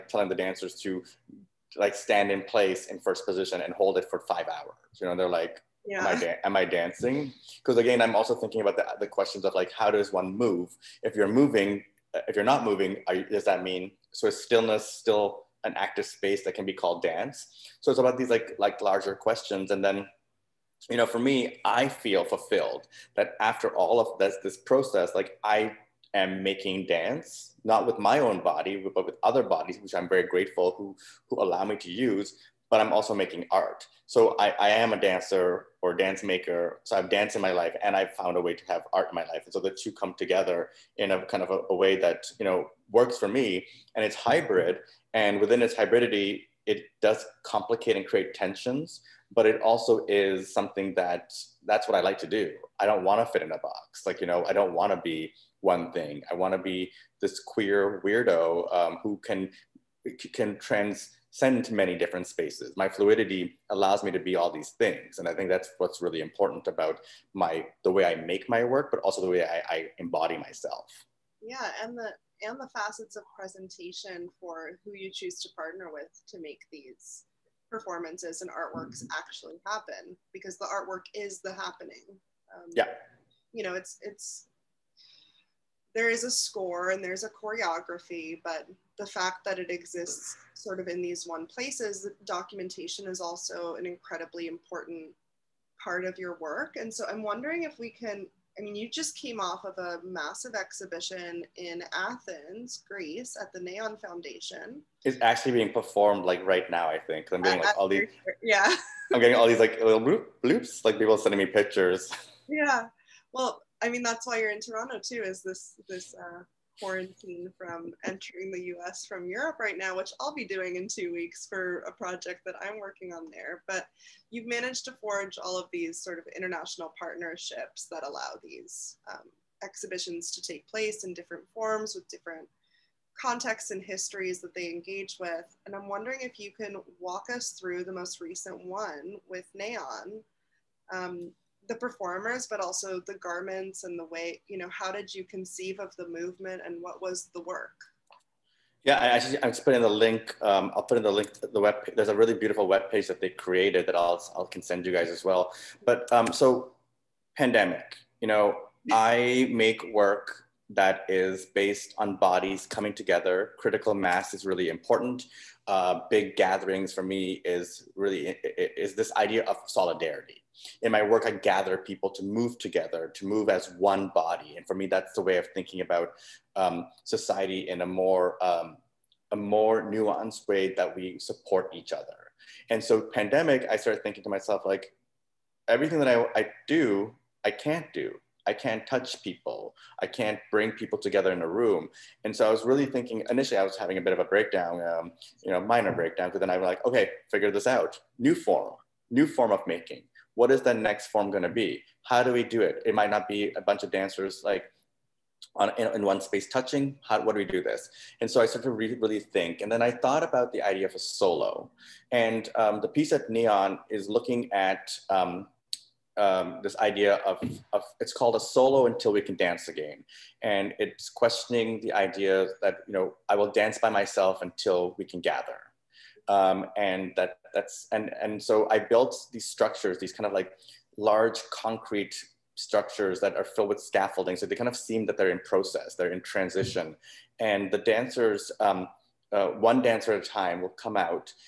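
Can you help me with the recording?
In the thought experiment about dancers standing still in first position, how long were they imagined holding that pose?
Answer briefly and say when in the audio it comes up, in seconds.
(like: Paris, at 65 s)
5 hours, at 4 s.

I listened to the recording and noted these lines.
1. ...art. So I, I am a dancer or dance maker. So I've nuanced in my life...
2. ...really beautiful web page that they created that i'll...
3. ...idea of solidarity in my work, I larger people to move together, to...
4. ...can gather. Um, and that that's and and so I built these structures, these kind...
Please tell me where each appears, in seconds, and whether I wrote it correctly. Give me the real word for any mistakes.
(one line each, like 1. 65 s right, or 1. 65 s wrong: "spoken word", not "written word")
1. 33 s wrong: "danced", not "nuanced"
2. 152 s right
3. 169 s wrong: "gather", not "larger"
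4. 225 s right.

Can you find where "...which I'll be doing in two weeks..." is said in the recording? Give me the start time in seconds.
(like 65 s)
119 s.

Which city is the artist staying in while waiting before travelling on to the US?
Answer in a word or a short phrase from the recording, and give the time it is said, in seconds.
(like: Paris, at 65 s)
Toronto, at 114 s.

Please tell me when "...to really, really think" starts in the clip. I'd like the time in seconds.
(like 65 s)
208 s.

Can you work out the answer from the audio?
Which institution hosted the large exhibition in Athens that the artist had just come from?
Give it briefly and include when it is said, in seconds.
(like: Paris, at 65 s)
Neon Foundation, at 103 s.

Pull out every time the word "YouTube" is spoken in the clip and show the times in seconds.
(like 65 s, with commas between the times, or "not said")
not said.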